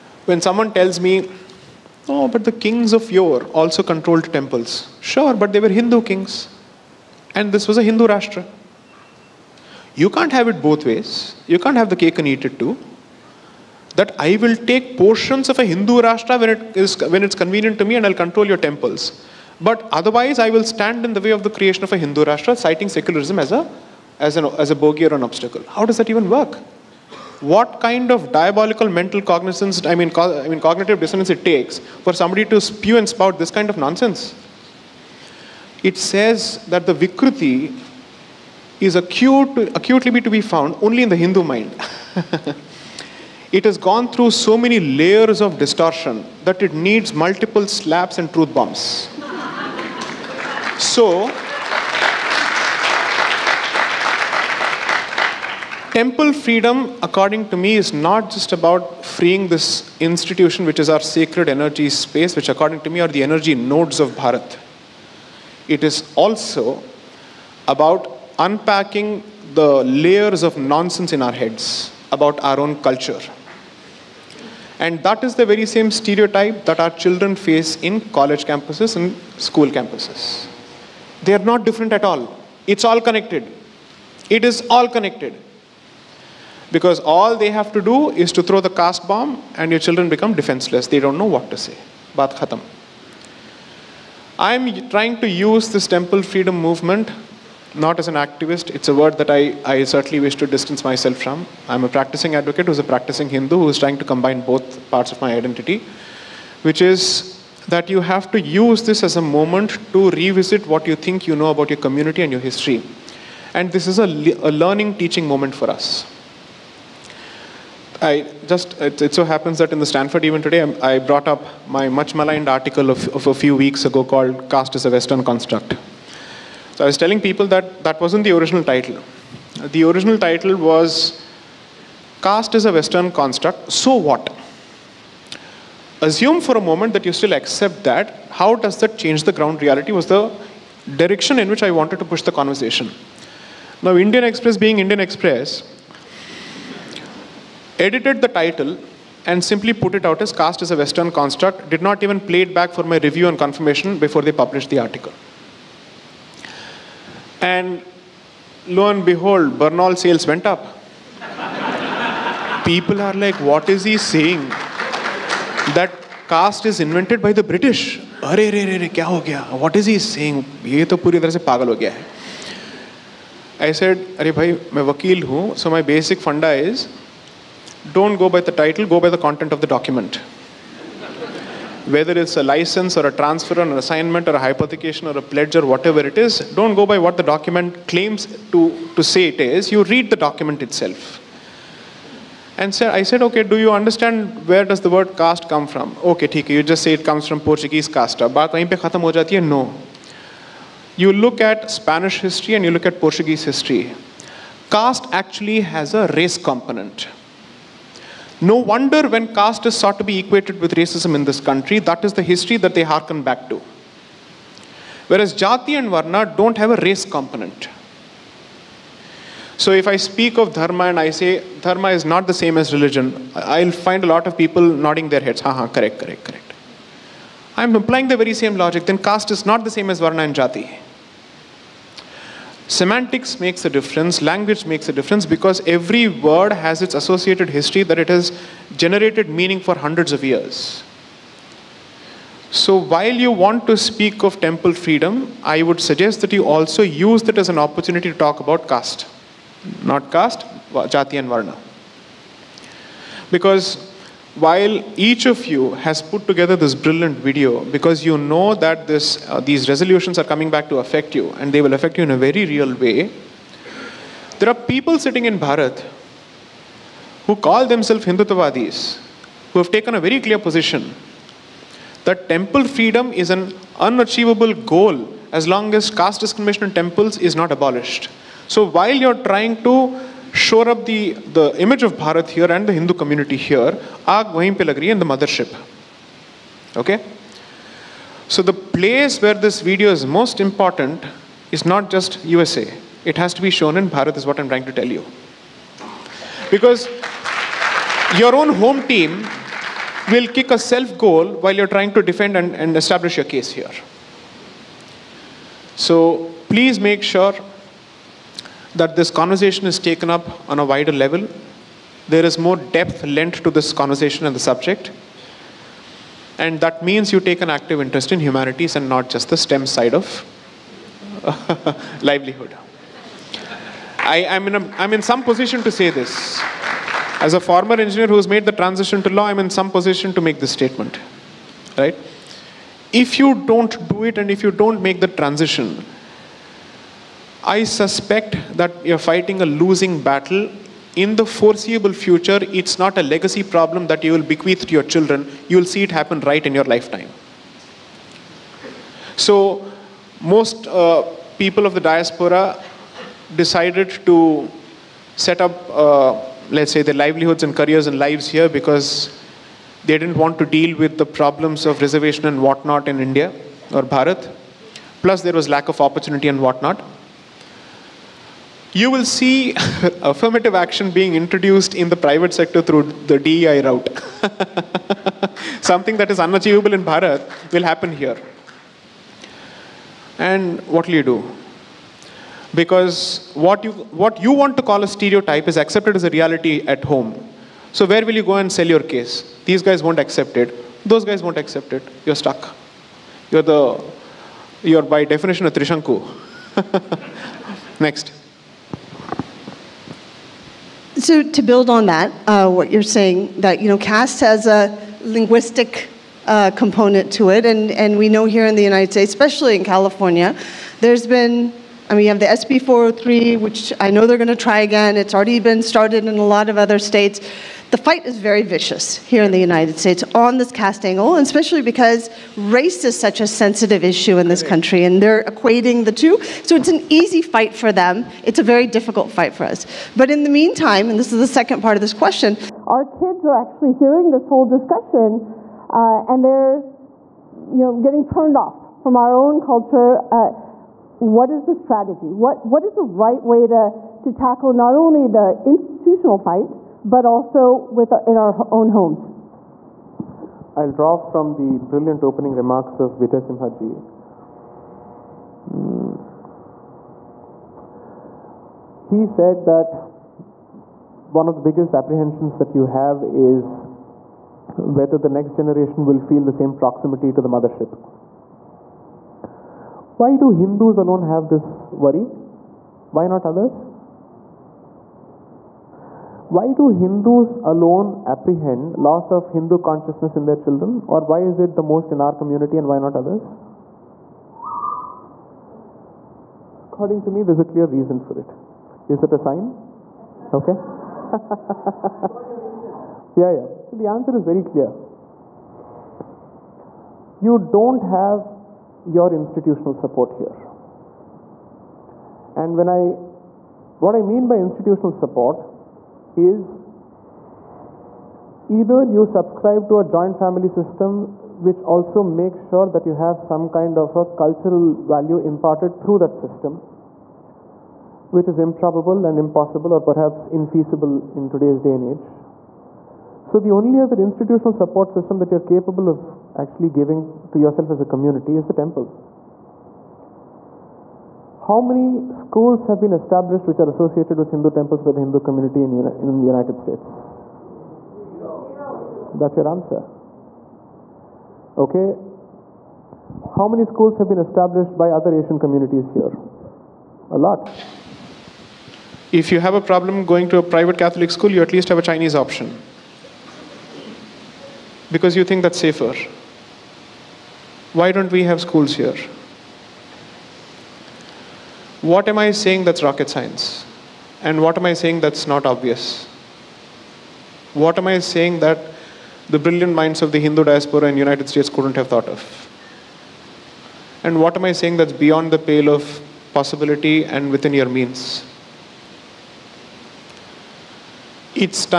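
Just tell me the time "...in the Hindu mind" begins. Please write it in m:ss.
0:41.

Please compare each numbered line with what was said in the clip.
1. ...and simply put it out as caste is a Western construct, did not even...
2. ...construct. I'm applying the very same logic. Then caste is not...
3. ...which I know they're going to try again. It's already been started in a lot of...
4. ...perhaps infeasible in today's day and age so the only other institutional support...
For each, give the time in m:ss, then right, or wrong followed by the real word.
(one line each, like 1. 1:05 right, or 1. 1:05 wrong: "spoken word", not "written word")
1. 2:29 right
2. 3:46 wrong: "correct", not "construct"
3. 6:53 right
4. 8:39 right.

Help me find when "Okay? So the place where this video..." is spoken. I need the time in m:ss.
4:46.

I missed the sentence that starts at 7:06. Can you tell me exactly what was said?
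So it's an easy fight for them.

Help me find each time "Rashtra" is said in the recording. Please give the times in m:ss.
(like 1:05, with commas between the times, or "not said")
0:08, 0:16, 0:22.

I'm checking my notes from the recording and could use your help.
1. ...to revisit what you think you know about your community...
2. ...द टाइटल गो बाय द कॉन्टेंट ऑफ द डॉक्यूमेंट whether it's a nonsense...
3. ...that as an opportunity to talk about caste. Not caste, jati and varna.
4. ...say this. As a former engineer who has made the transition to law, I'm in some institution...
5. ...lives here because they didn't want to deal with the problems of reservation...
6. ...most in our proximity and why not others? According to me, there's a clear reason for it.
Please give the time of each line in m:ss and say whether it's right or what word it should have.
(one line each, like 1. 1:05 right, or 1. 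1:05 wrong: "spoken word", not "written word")
1. 1:49 right
2. 2:58 wrong: "license", not "nonsense"
3. 4:07 right
4. 5:25 wrong: "position", not "institution"
5. 5:57 right
6. 8:01 wrong: "community", not "proximity".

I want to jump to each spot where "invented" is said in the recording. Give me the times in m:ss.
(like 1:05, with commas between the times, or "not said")
2:46.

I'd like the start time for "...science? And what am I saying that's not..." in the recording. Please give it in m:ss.
9:23.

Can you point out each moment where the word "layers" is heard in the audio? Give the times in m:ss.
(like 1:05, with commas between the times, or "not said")
0:44, 1:09.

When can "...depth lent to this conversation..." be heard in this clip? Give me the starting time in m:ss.
5:12.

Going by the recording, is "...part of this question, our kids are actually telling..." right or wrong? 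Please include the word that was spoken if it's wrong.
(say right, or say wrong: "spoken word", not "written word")
wrong: "hearing", not "telling".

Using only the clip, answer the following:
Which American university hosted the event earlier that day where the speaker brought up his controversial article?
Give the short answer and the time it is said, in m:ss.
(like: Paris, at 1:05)
Stanford, at 1:59.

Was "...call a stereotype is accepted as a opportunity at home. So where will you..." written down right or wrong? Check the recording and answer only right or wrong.
wrong.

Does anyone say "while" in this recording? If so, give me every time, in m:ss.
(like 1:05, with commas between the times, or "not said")
4:02, 4:14, 4:38, 5:01.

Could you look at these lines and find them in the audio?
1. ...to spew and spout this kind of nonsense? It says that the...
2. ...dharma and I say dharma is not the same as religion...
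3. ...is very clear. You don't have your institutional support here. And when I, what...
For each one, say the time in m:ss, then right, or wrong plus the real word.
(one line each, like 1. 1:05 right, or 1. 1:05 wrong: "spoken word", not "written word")
1. 0:32 right
2. 3:40 right
3. 8:14 right.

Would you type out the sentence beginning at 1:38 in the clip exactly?
It's a word that I, I certainly wish to distance myself from.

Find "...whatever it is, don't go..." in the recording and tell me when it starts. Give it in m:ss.
3:05.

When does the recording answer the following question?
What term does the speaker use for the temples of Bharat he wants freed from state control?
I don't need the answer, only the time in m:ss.
1:03.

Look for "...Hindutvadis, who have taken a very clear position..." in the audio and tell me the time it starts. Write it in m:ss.
4:28.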